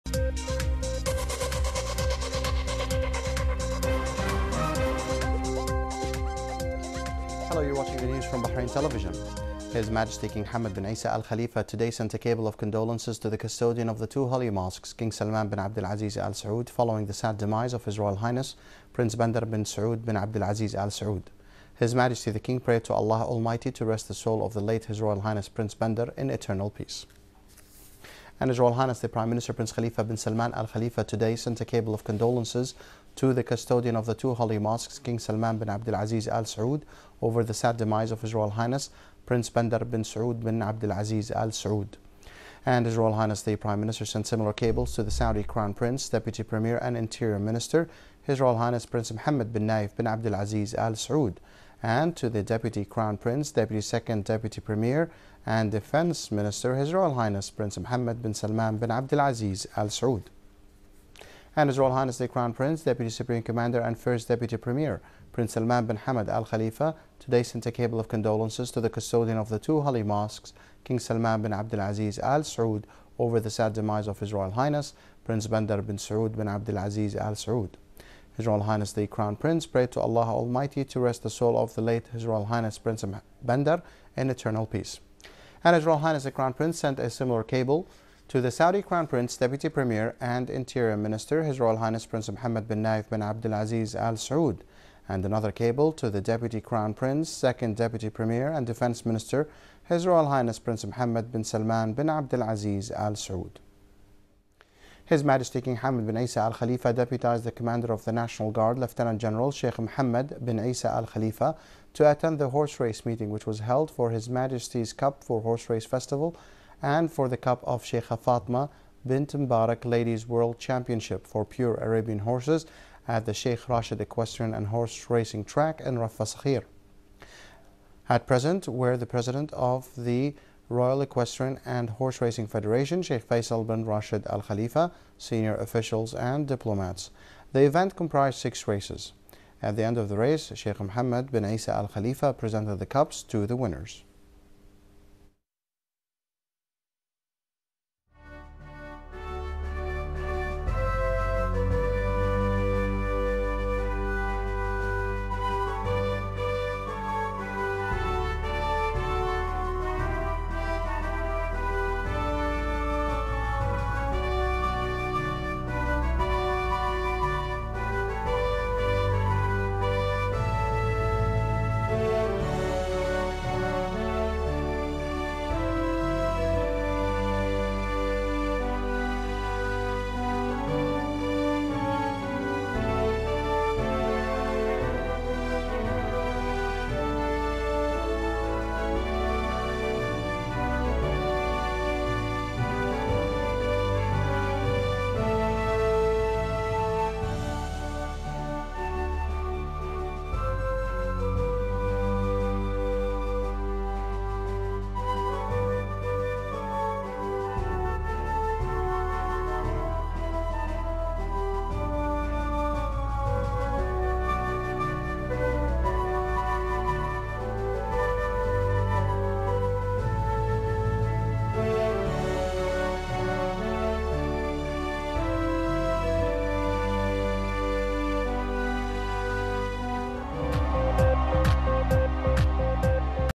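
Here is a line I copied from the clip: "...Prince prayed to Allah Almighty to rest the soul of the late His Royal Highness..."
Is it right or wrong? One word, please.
right.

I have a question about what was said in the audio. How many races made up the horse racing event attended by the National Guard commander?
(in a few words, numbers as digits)
6.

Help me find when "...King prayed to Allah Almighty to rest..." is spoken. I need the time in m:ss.
0:22.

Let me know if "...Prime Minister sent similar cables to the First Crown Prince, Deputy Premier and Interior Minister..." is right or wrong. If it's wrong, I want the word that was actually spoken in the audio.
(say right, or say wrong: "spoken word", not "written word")
wrong: "Saudi", not "First".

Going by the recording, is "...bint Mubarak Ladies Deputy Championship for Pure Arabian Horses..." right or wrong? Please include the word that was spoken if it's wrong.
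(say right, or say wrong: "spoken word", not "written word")
wrong: "World", not "Deputy".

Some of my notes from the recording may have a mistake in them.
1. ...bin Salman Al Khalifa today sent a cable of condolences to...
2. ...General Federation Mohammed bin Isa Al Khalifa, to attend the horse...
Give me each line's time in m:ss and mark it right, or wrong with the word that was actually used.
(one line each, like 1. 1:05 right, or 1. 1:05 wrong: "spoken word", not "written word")
1. 0:30 right
2. 1:49 wrong: "Sheikh", not "Federation".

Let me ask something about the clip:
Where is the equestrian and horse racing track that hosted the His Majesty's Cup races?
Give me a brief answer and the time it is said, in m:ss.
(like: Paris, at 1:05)
Rafa Sakhir, at 2:05.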